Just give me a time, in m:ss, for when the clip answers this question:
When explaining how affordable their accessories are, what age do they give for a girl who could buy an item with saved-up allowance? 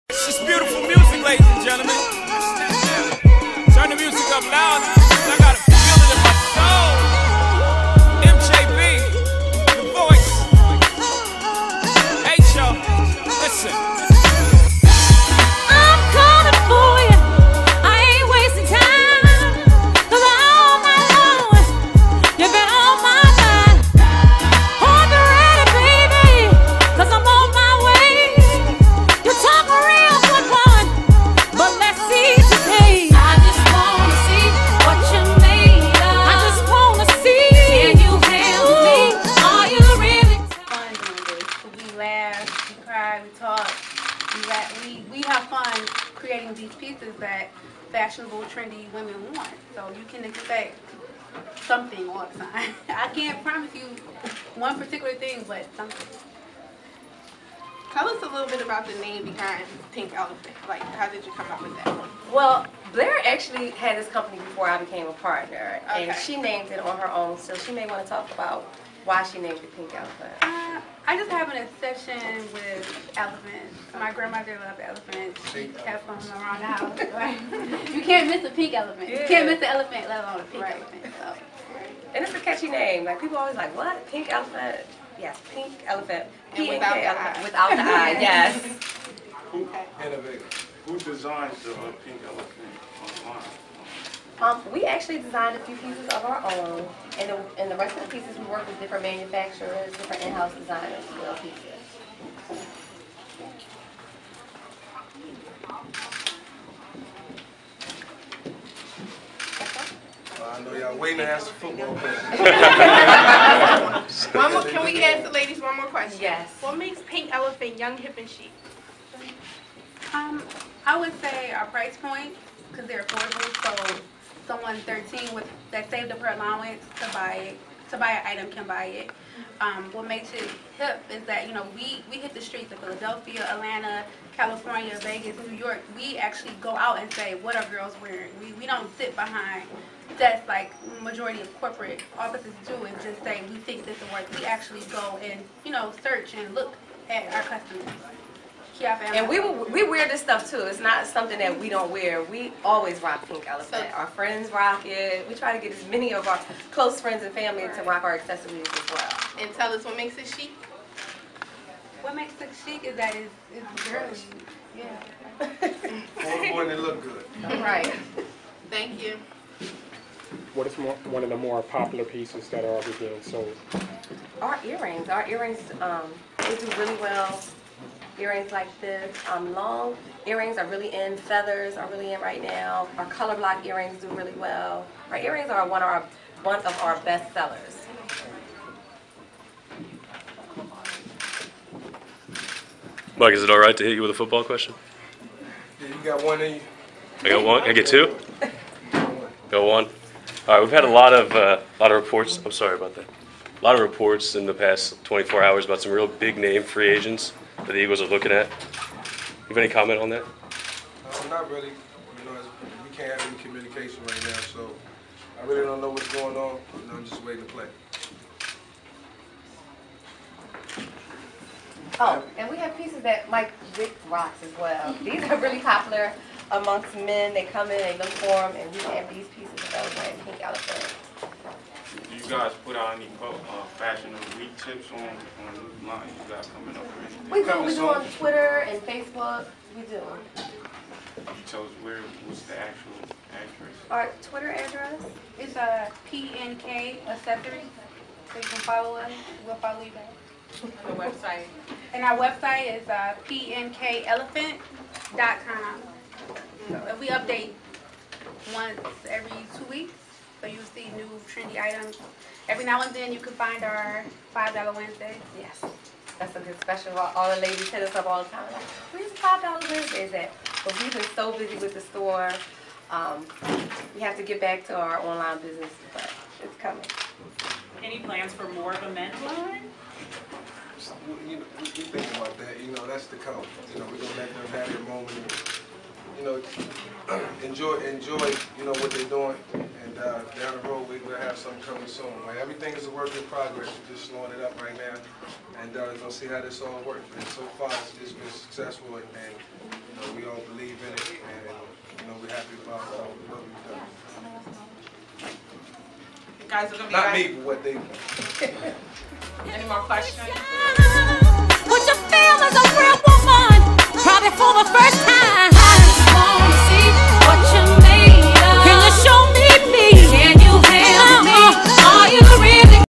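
2:04.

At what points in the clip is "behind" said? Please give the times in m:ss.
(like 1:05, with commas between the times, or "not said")
0:59, 2:19.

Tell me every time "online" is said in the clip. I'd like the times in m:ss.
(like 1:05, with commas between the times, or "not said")
1:33, 4:34.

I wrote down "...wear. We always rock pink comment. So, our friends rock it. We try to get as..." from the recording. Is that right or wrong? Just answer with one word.
wrong.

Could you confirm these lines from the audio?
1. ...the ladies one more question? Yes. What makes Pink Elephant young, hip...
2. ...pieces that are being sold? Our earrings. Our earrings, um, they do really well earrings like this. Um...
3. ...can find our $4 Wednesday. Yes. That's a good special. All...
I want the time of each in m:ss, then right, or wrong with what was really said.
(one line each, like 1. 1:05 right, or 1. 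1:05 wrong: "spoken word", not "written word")
1. 1:55 right
2. 2:52 right
3. 4:23 wrong: "5", not "4".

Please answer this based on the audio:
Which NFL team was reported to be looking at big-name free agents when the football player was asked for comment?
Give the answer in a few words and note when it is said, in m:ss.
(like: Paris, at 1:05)
Eagles, at 3:27.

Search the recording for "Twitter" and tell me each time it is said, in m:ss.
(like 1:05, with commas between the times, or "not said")
3:58, 4:04.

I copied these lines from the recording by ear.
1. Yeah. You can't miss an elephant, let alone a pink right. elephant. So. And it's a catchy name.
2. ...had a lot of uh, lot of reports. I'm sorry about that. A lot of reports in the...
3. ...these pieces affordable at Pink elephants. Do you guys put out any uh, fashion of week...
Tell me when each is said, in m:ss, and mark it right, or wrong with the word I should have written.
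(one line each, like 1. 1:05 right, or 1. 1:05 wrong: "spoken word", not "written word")
1. 1:19 right
2. 3:20 right
3. 3:49 wrong: "available", not "affordable".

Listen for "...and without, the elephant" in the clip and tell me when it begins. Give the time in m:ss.
1:26.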